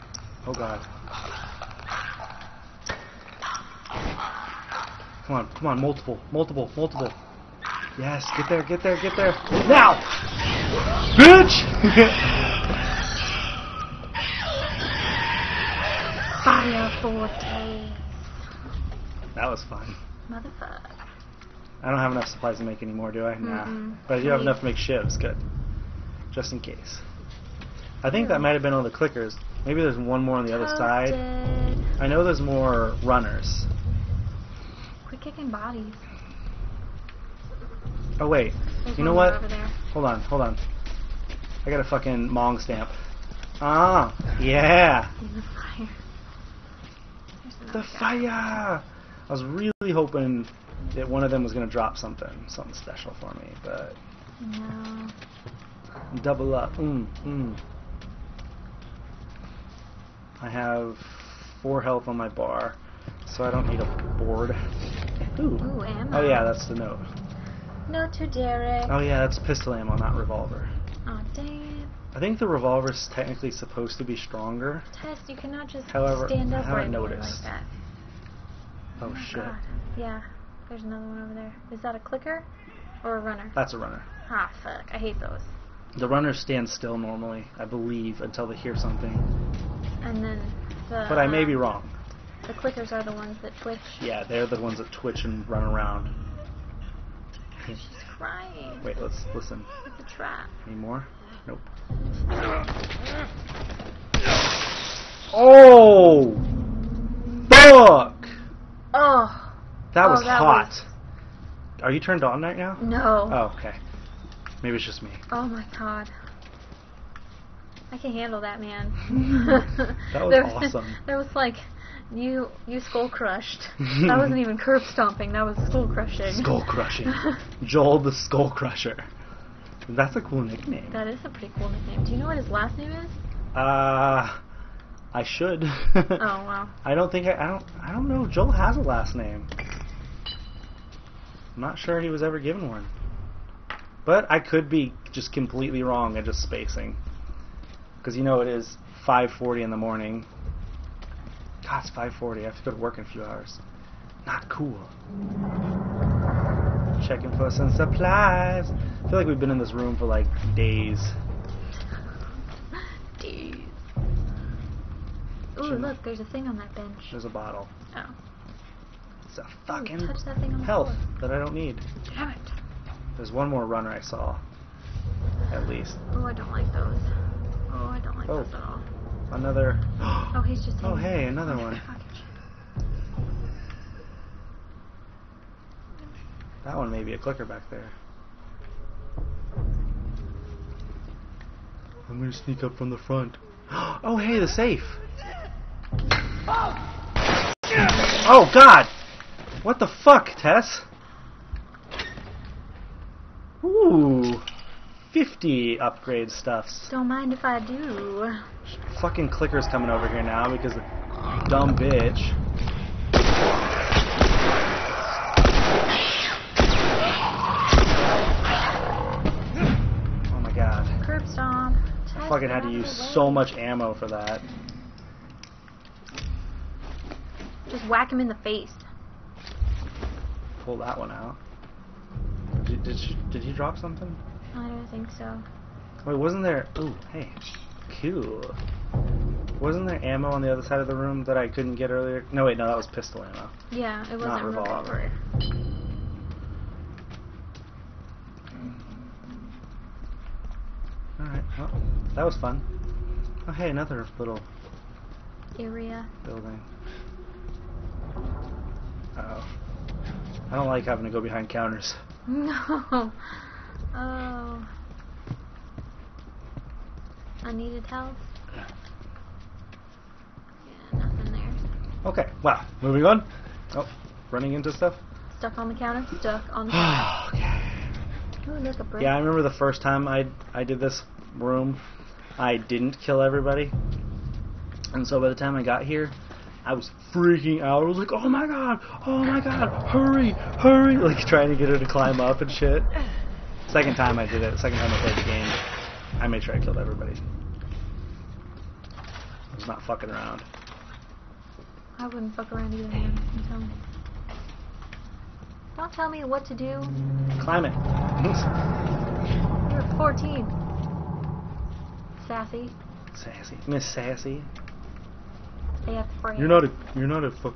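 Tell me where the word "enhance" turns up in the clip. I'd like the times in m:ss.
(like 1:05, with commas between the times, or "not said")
not said.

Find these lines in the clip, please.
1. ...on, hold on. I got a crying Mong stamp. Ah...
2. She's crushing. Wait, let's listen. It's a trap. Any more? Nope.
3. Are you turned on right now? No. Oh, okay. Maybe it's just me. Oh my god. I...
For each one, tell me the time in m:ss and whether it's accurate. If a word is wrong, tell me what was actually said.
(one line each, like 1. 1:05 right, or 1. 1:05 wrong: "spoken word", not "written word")
1. 0:40 wrong: "fucking", not "crying"
2. 1:37 wrong: "crying", not "crushing"
3. 1:51 right.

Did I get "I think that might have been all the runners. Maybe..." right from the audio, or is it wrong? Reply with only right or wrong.
wrong.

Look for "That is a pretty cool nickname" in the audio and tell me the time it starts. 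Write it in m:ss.
2:10.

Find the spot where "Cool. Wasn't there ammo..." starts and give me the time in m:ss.
3:58.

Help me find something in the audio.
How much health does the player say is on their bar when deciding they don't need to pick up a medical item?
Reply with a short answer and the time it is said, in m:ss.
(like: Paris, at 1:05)
4, at 1:01.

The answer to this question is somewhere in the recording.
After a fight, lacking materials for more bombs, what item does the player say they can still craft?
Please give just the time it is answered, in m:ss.
0:24.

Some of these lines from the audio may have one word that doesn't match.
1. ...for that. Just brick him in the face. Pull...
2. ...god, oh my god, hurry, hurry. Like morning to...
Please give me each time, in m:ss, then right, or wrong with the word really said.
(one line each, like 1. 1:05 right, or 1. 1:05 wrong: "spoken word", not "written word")
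1. 3:43 wrong: "whack", not "brick"
2. 4:48 wrong: "trying", not "morning".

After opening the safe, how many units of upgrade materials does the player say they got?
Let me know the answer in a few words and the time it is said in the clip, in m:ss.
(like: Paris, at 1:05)
50, at 3:25.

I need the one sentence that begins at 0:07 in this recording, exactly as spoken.
Yes, get there, get there, get there.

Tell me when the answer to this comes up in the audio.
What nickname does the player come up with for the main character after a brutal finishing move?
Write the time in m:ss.
2:07.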